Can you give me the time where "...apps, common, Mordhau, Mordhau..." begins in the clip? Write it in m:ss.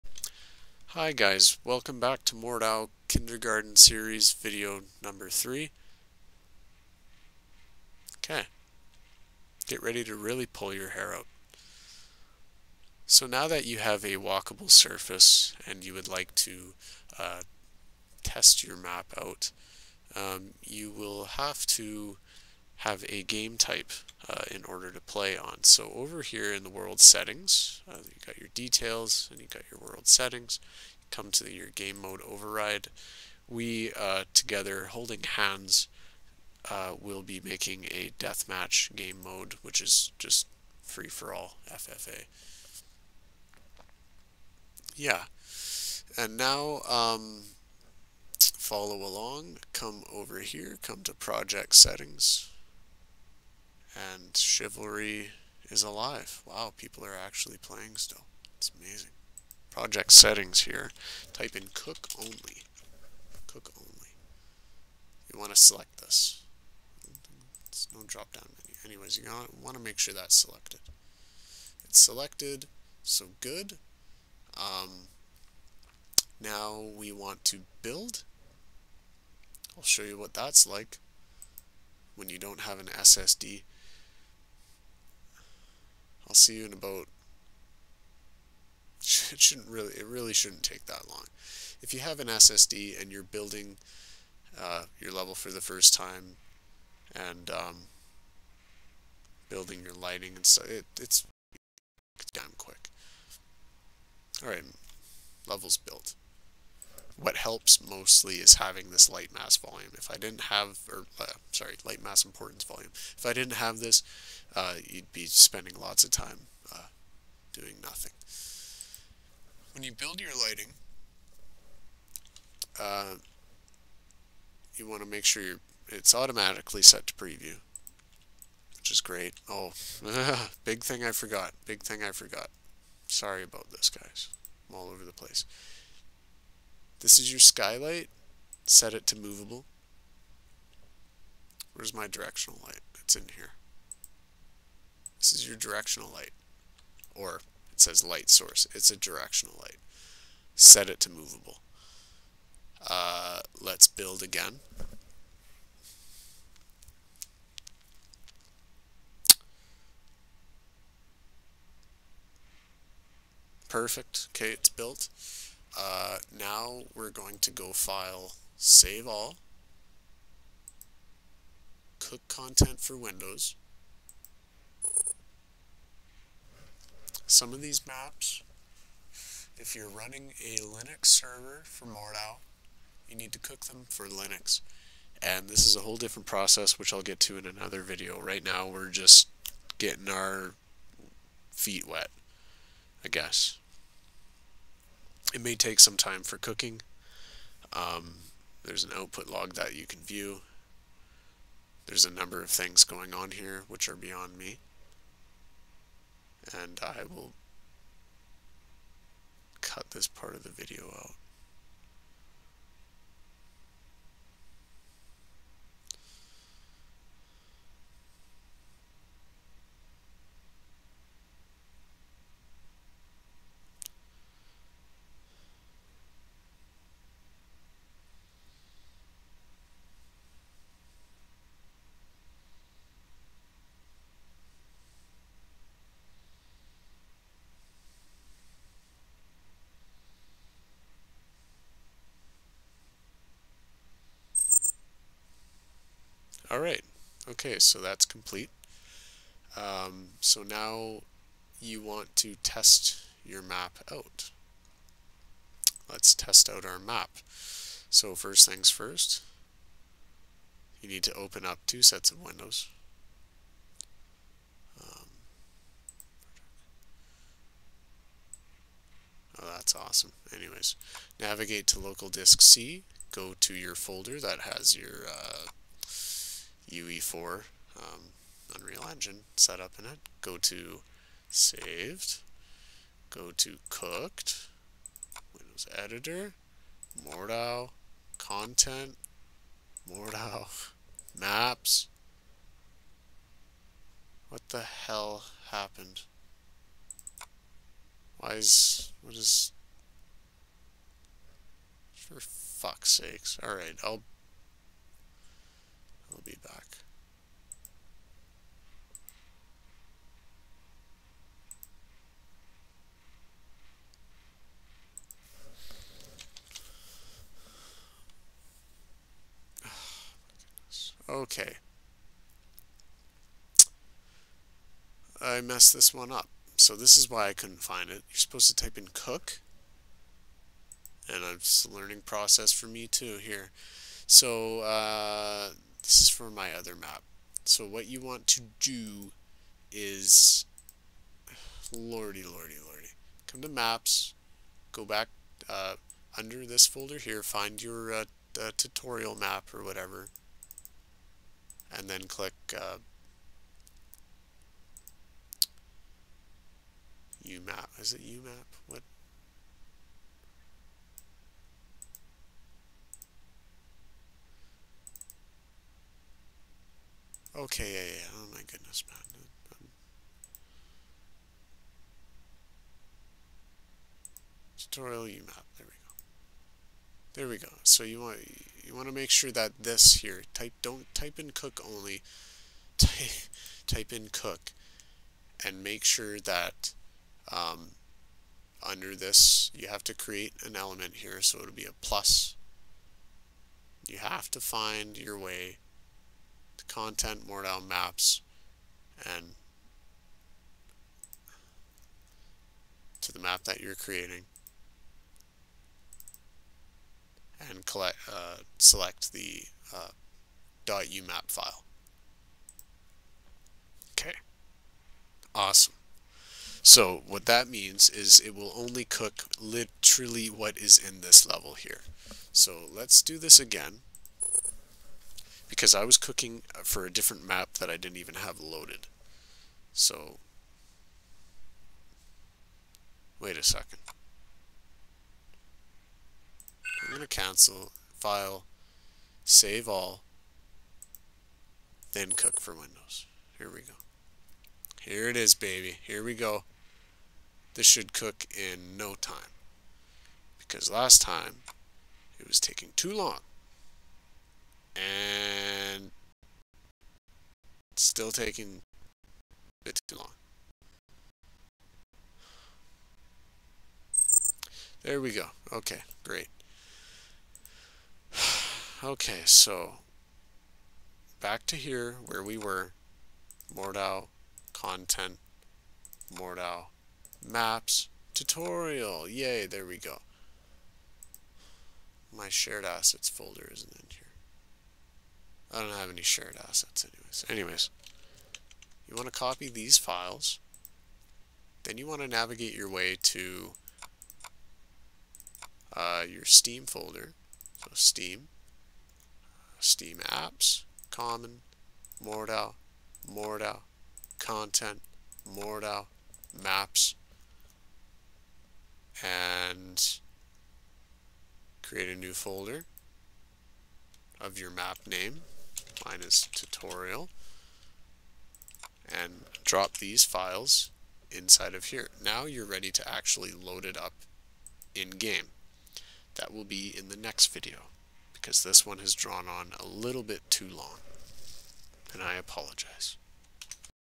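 8:20.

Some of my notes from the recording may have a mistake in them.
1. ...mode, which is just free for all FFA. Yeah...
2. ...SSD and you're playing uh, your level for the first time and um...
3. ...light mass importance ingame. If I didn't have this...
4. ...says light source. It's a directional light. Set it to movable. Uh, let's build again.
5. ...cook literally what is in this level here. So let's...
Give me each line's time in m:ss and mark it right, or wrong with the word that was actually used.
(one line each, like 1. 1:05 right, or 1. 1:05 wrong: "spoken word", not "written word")
1. 0:39 right
2. 1:32 wrong: "building", not "playing"
3. 1:51 wrong: "volume", not "ingame"
4. 2:27 right
5. 6:58 right.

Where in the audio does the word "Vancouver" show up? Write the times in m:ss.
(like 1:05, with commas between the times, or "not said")
not said.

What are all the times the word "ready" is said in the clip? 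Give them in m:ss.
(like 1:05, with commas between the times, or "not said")
0:09, 8:42.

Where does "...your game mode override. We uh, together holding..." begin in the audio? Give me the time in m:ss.
0:31.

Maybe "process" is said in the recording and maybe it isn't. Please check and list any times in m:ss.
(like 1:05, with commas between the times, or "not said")
3:06, 5:32.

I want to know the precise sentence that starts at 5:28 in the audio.
You're supposed to type in cook.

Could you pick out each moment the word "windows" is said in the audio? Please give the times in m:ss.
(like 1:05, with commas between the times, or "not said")
2:52, 4:22, 4:45, 7:22.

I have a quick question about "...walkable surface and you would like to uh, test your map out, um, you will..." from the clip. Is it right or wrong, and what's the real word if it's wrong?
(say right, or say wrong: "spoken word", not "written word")
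right.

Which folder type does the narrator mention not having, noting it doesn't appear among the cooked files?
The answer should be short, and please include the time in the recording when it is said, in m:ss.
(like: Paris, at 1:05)
Shared assets folder, at 8:02.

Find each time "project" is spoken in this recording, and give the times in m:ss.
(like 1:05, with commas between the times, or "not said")
0:51, 0:59.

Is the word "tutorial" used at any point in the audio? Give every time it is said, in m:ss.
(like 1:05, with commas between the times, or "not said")
5:48, 6:14, 7:58, 8:36.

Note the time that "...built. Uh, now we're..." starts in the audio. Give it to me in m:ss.
2:44.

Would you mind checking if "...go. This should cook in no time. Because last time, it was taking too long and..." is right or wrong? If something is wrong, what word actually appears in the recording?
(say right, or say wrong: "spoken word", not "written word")
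right.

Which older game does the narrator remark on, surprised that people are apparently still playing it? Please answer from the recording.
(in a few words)
Chivalry.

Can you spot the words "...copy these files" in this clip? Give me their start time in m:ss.
8:09.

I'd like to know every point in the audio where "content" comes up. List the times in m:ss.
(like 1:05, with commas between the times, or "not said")
2:52, 4:48, 6:36, 7:54, 8:24.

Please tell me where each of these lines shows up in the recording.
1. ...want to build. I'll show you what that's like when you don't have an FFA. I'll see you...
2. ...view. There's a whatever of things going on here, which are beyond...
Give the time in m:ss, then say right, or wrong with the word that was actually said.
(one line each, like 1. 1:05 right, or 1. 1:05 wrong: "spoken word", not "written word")
1. 1:17 wrong: "SSD", not "FFA"
2. 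3:20 wrong: "number", not "whatever".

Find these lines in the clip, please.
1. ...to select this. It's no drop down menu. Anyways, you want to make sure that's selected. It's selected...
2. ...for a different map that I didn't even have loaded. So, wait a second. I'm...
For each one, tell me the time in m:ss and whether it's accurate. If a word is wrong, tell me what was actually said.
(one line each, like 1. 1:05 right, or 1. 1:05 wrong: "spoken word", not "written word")
1. 1:05 right
2. 7:06 right.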